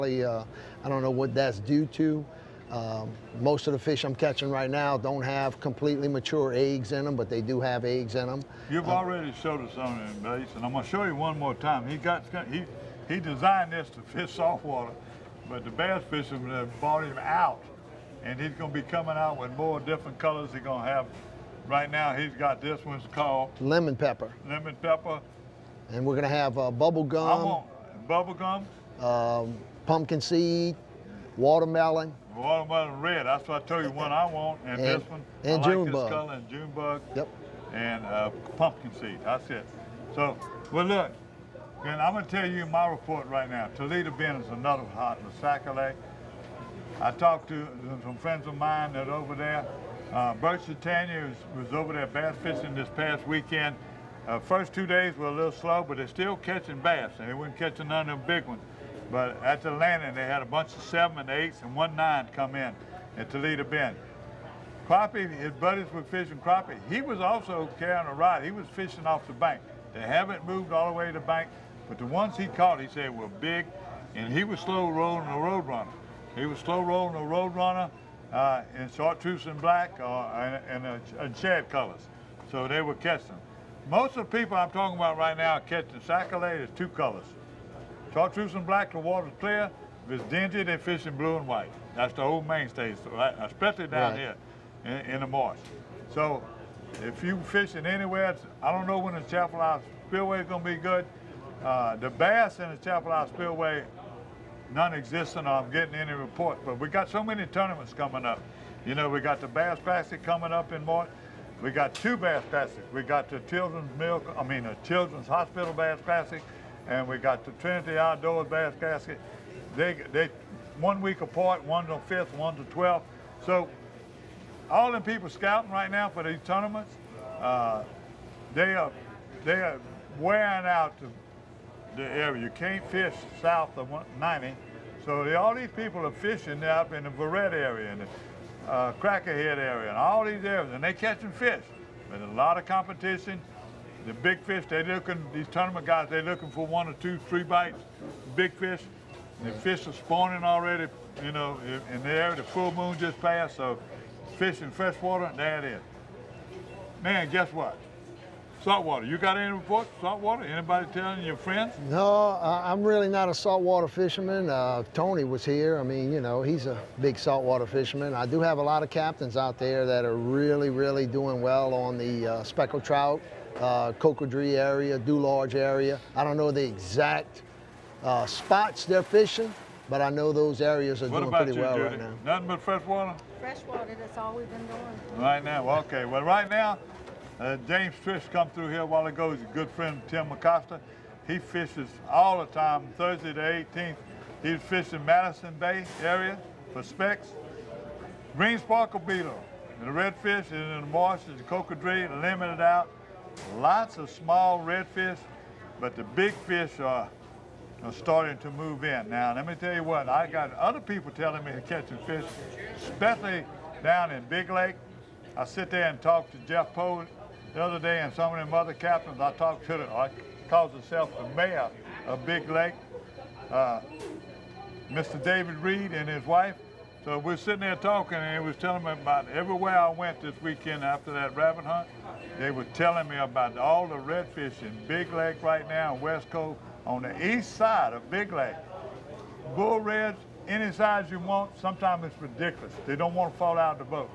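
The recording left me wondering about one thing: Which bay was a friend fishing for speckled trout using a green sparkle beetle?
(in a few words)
Madison Bay.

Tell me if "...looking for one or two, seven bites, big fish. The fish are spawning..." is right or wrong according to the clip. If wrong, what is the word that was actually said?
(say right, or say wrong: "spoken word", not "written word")
wrong: "three", not "seven".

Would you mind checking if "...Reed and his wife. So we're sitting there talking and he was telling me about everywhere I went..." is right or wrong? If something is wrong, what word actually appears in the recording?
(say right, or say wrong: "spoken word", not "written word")
right.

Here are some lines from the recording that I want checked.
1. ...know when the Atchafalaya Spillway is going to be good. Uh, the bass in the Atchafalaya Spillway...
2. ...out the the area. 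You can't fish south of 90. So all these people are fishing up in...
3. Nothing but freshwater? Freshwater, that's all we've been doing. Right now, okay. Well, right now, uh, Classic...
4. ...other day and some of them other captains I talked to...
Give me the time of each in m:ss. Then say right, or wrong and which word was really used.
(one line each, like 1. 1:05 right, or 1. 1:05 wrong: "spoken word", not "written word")
1. 1:38 right
2. 2:10 right
3. 3:02 wrong: "James", not "Classic"
4. 3:37 right.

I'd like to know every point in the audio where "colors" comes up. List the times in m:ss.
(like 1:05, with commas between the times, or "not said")
0:20, 0:36, 1:21, 1:26.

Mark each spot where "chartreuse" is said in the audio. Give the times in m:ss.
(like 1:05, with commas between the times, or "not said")
1:18, 1:28.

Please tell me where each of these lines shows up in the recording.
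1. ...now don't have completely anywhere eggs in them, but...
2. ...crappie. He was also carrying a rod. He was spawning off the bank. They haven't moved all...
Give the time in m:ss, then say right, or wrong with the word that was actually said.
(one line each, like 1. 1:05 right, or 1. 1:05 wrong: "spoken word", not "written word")
1. 0:04 wrong: "mature", not "anywhere"
2. 1:06 wrong: "fishing", not "spawning".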